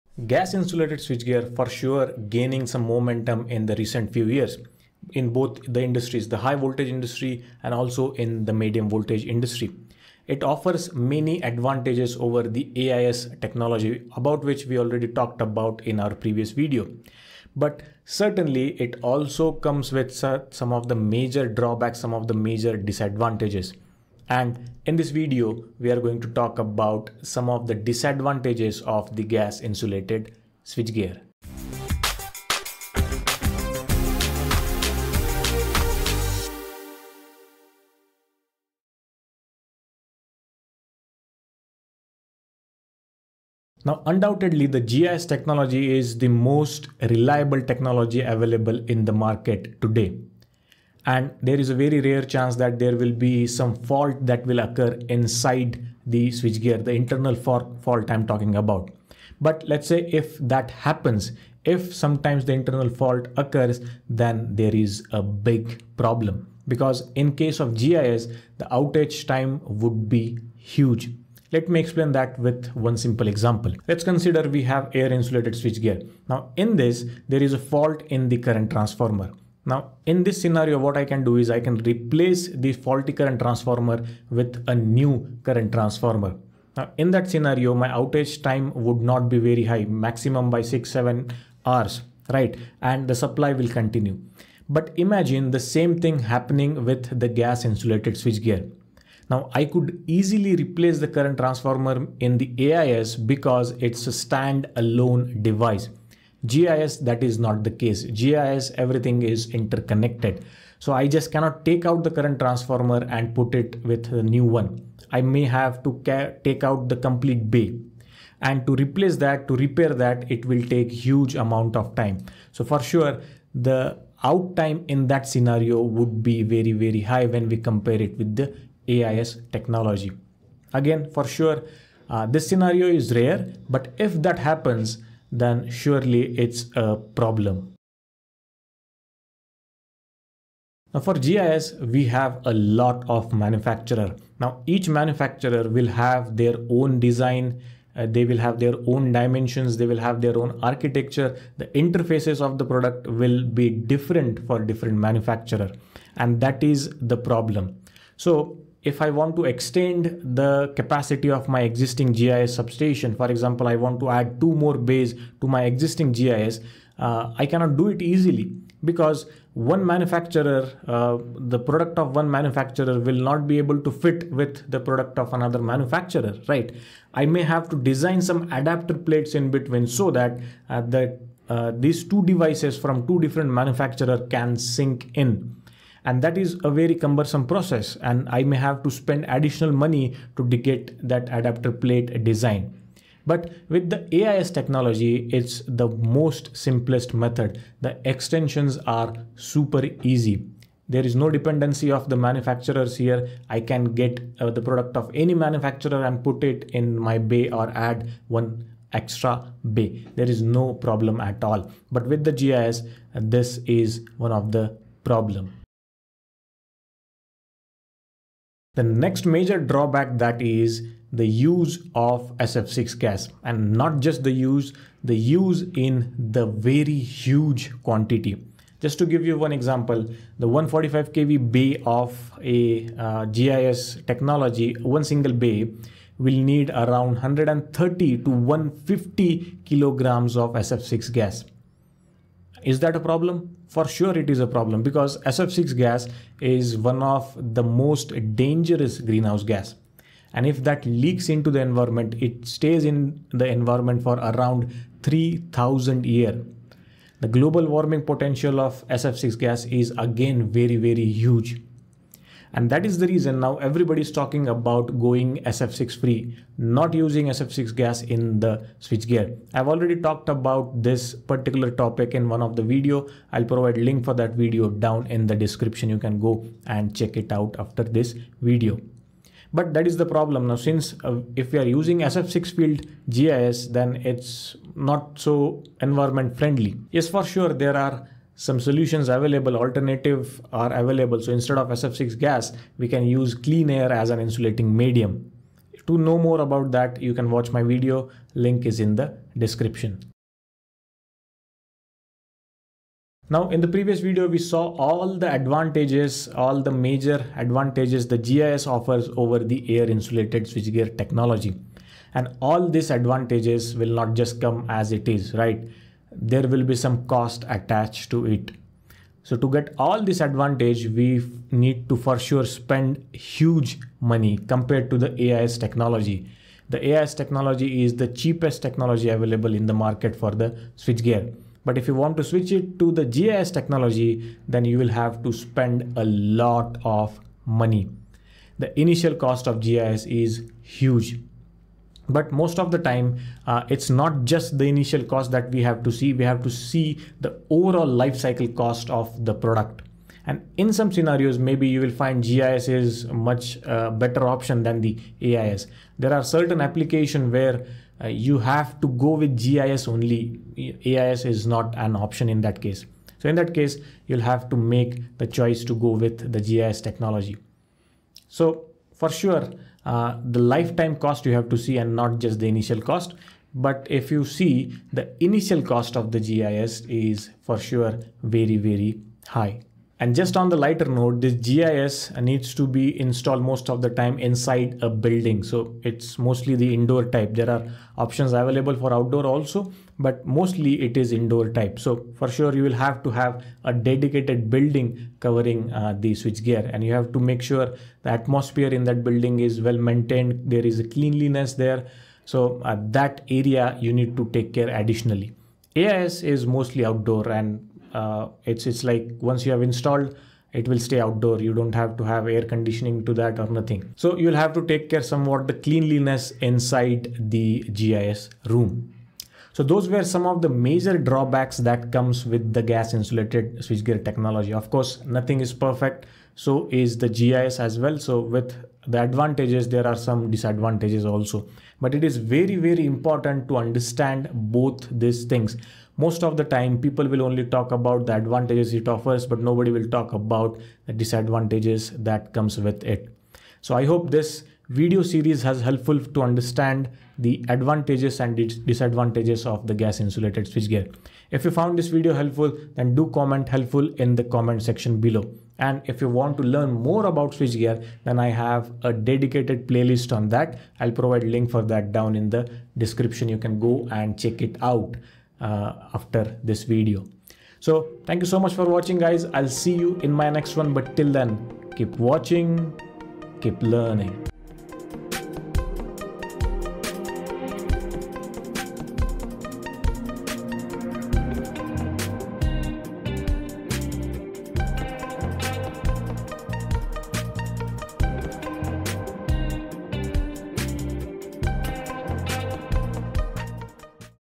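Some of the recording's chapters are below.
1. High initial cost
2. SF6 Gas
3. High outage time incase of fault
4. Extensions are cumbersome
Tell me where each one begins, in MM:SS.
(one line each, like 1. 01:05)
1. 05:00
2. 03:36
3. 00:39
4. 02:18.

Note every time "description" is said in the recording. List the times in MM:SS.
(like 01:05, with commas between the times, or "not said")
04:35, 04:59, 07:42.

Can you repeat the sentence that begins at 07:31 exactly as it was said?
If you found this video helpful, then do comment helpful in the comment section below.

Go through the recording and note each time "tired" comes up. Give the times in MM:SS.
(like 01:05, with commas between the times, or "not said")
not said.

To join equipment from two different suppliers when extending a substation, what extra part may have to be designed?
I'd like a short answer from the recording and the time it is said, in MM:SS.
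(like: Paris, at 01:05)
Adapter plates, at 02:58.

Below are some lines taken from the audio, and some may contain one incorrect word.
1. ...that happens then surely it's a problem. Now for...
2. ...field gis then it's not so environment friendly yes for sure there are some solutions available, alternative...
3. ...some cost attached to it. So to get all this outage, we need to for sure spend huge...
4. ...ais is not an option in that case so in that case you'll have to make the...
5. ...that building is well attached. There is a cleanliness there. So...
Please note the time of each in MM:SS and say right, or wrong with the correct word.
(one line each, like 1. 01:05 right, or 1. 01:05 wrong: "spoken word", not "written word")
1. 02:14 right
2. 04:42 right
3. 05:16 wrong: "advantage", not "outage"
4. 06:00 right
5. 06:38 wrong: "maintained", not "attached".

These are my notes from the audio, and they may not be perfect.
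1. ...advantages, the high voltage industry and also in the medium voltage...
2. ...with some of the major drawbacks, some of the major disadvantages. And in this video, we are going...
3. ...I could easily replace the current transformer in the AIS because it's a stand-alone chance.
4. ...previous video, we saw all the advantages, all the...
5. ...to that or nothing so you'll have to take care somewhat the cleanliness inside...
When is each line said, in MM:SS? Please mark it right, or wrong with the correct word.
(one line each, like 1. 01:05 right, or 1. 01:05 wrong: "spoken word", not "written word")
1. 00:05 wrong: "industries", not "advantages"
2. 00:19 right
3. 01:39 wrong: "device", not "chance"
4. 05:03 right
5. 06:53 right.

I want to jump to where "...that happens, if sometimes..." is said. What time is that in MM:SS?
01:00.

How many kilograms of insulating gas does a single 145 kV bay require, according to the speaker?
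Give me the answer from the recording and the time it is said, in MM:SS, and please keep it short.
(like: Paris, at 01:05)
130 to 150 kg, at 03:57.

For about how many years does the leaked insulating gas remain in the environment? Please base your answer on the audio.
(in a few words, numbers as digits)
3000 years.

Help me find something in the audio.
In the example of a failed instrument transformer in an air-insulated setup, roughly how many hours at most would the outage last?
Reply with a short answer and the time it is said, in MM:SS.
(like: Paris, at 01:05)
6-7 hours, at 01:30.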